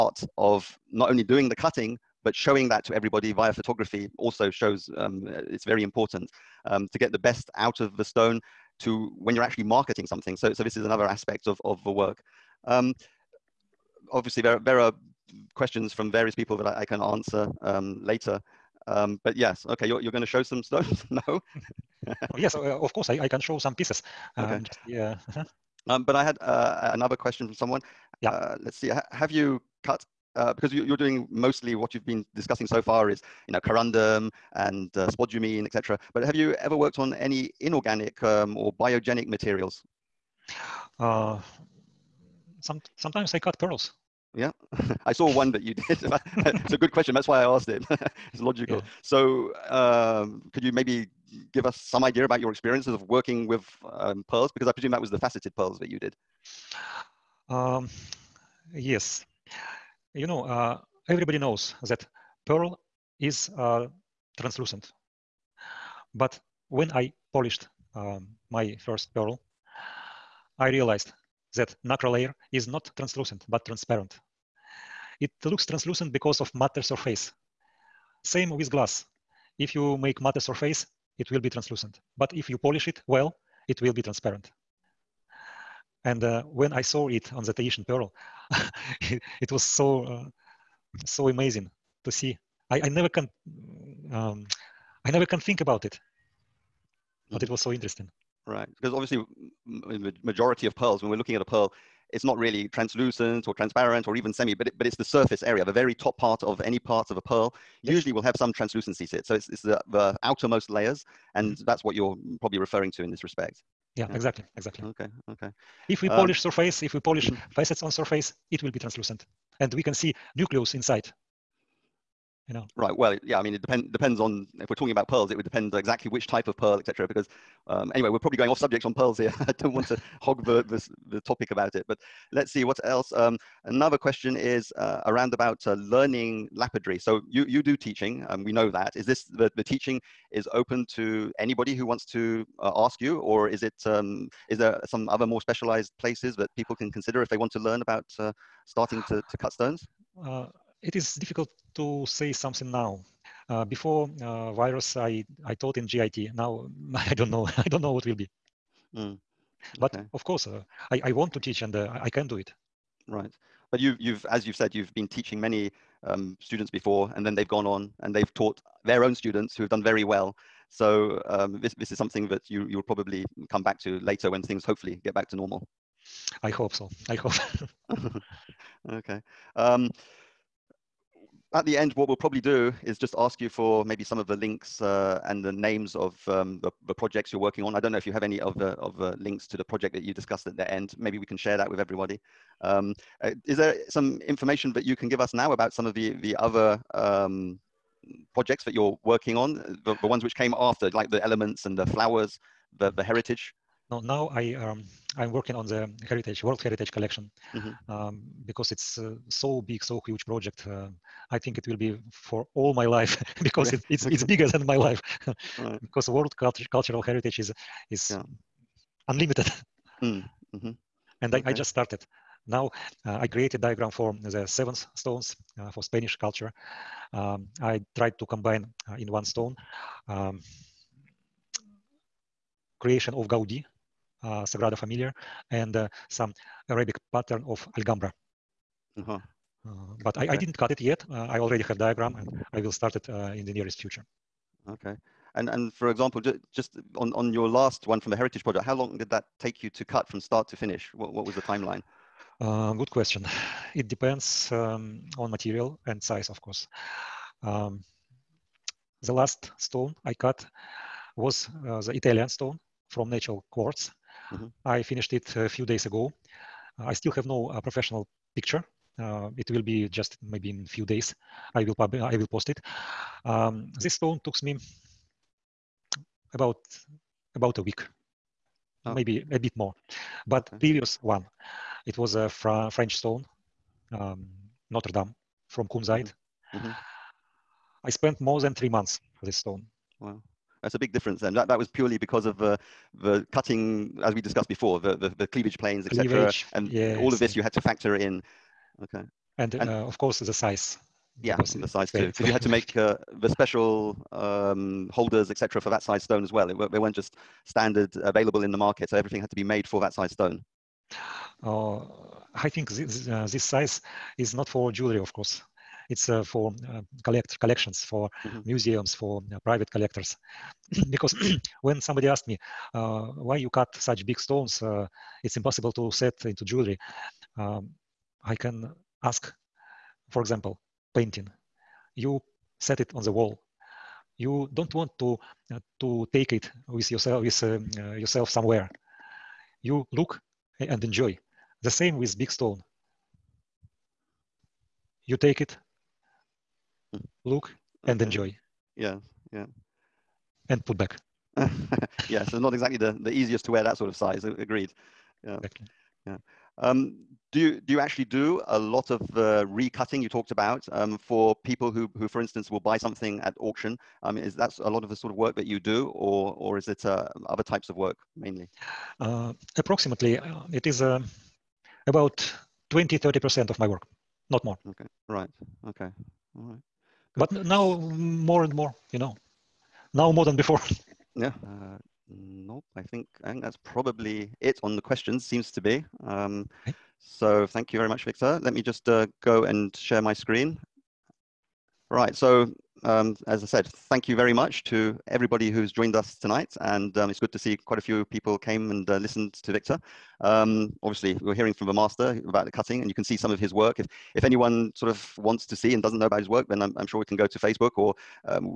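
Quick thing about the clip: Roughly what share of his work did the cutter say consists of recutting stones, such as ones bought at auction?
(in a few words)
20-30 percent.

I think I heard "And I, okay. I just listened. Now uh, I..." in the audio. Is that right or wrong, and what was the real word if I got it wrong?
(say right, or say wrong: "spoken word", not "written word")
wrong: "started", not "listened".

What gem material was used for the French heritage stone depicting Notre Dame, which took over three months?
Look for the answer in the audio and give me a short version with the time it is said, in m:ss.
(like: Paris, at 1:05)
Kunzite, at 4:45.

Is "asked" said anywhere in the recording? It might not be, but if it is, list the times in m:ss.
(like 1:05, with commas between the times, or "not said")
0:47, 5:22.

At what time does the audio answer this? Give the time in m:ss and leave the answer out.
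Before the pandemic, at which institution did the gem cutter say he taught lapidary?
2:35.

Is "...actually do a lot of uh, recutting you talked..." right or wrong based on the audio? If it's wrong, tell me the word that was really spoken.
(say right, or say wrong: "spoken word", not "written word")
right.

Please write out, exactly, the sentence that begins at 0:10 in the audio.
So, so this is another aspect of, of the work.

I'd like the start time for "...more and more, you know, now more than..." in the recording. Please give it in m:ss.
6:18.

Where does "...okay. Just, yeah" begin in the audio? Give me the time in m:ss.
0:24.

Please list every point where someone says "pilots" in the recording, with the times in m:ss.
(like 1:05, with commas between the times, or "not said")
not said.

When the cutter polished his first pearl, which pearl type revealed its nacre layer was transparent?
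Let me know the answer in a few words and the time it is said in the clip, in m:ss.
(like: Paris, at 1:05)
Tahitian pearl, at 1:27.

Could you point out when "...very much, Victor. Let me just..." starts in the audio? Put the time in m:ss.
6:27.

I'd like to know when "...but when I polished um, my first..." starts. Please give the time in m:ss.
1:06.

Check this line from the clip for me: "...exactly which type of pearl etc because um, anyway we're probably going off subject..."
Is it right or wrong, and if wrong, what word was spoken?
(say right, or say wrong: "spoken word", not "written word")
right.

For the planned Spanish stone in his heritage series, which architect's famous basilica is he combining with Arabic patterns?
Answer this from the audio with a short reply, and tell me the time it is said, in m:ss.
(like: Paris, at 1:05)
Gaudi, at 3:53.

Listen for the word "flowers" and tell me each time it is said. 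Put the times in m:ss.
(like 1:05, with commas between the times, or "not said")
3:21.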